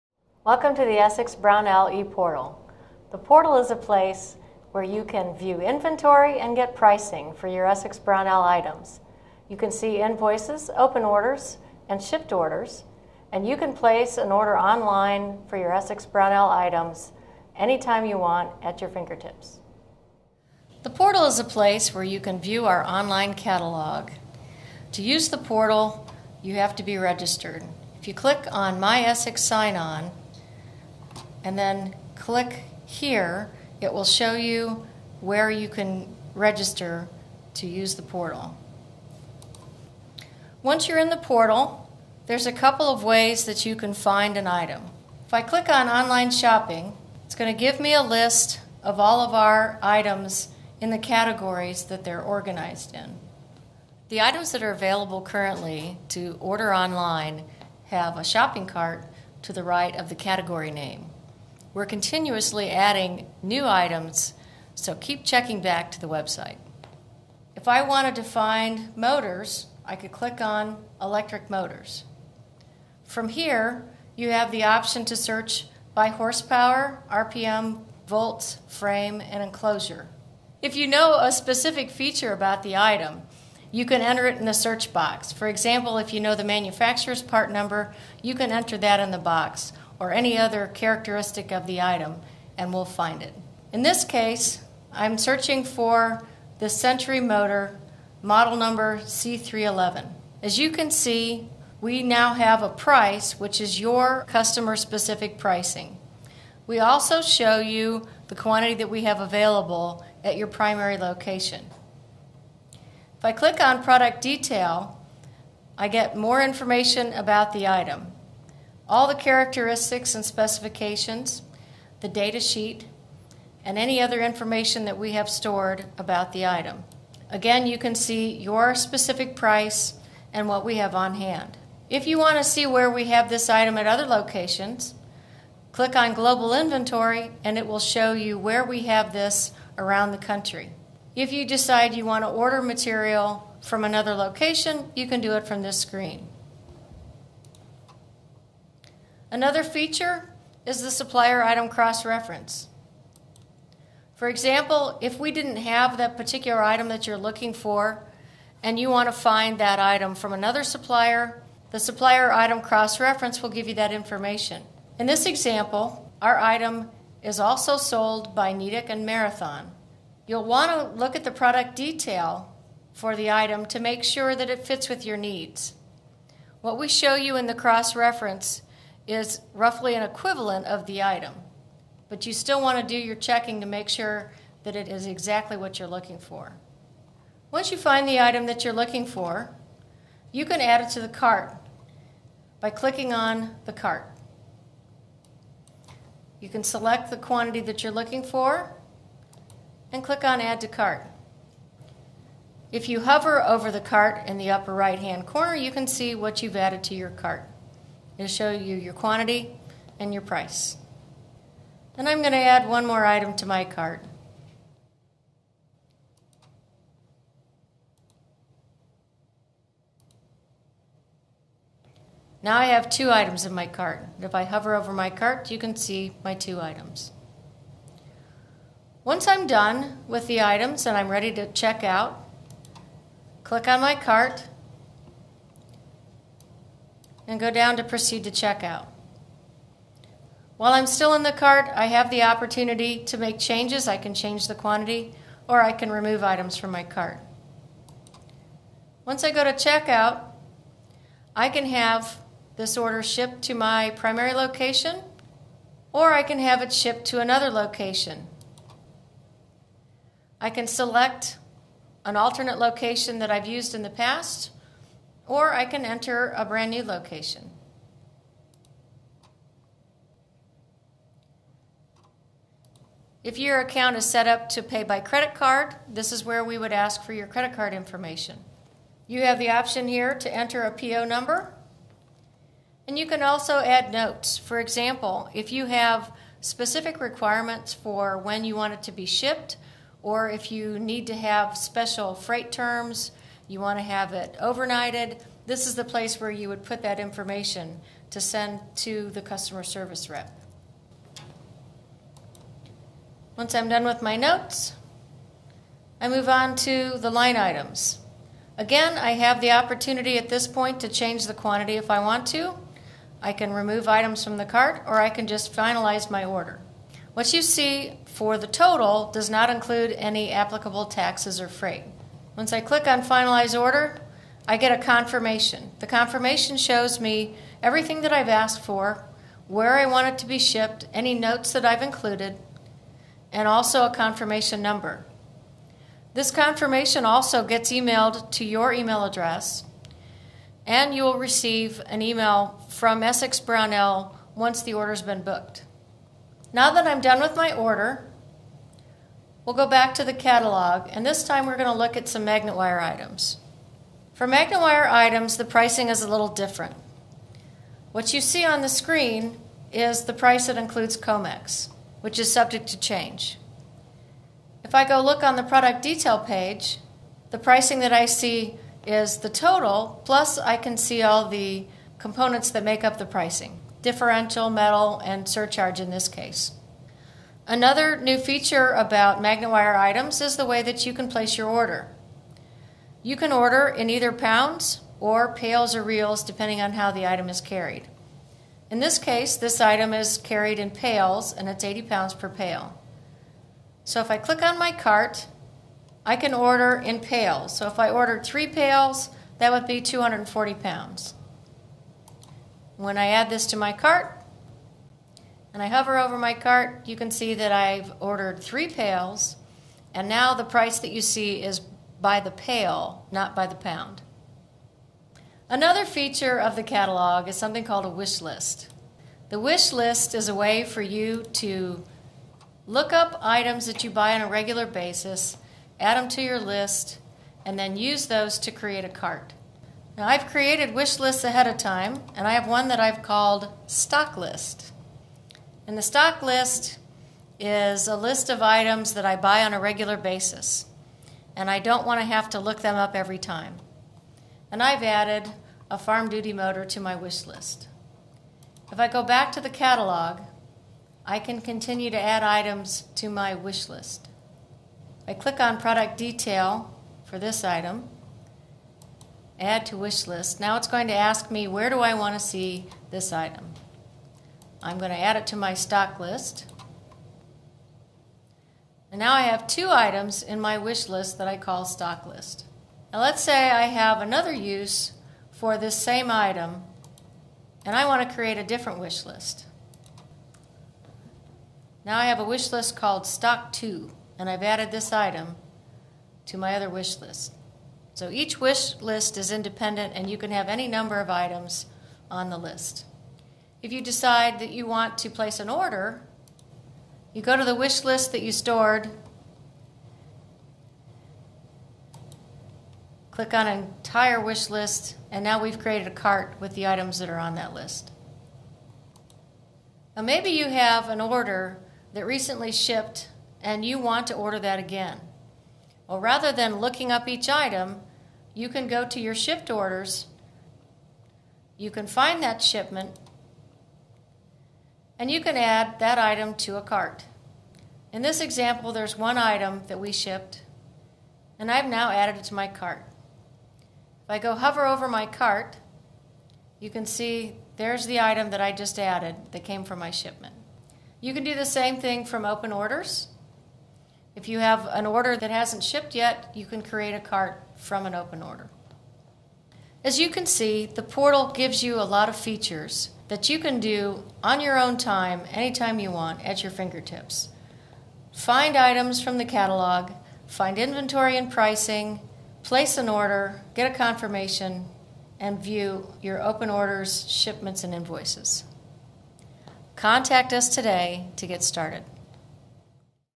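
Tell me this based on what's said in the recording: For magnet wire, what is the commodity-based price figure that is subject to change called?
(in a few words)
COMEX.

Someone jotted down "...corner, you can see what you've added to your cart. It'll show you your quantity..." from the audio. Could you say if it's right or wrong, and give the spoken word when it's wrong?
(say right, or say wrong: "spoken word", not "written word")
right.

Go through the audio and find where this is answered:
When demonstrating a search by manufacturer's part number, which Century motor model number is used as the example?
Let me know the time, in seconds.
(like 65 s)
99 s.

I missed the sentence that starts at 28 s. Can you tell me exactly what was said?
If you click on My Essex Sign On, and then click here.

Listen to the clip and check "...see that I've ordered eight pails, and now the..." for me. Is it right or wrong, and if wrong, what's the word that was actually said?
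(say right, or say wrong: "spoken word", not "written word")
wrong: "three", not "eight".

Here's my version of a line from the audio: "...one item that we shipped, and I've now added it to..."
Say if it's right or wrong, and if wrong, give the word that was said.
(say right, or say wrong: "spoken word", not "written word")
right.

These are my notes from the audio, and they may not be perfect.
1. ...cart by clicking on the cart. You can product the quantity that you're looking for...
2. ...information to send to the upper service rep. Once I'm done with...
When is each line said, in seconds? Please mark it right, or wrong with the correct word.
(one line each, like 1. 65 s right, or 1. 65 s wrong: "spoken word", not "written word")
1. 191 s wrong: "select", not "product"
2. 297 s wrong: "customer", not "upper".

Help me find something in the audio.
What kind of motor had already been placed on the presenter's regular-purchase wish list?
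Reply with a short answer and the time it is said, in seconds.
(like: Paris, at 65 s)
farm duty motor, at 445 s.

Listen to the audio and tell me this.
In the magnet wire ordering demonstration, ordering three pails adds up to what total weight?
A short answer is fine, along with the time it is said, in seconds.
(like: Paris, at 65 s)
240 pounds, at 399 s.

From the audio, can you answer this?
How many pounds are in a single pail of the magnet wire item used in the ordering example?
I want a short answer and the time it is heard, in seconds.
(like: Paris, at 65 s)
80 pounds, at 391 s.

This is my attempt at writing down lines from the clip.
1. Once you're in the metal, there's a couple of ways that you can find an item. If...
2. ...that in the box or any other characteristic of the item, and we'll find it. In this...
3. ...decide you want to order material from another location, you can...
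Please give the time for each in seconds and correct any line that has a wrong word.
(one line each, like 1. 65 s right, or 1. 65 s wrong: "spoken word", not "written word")
1. 40 s wrong: "portal", not "metal"
2. 88 s right
3. 141 s right.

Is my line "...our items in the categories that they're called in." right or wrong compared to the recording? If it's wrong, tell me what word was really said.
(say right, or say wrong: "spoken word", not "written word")
wrong: "organized", not "called".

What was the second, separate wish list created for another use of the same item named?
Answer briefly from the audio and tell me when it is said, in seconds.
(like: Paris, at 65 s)
stock 2, at 483 s.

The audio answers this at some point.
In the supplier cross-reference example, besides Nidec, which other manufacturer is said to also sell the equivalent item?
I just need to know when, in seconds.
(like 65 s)
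169 s.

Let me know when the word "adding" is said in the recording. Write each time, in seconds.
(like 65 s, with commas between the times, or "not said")
62 s.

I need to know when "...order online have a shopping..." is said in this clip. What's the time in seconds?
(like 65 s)
56 s.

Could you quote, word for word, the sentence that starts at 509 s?
Now maybe you have an order that recently shipped and you want to order that again.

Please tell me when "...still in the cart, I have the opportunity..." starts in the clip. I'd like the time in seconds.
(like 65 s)
240 s.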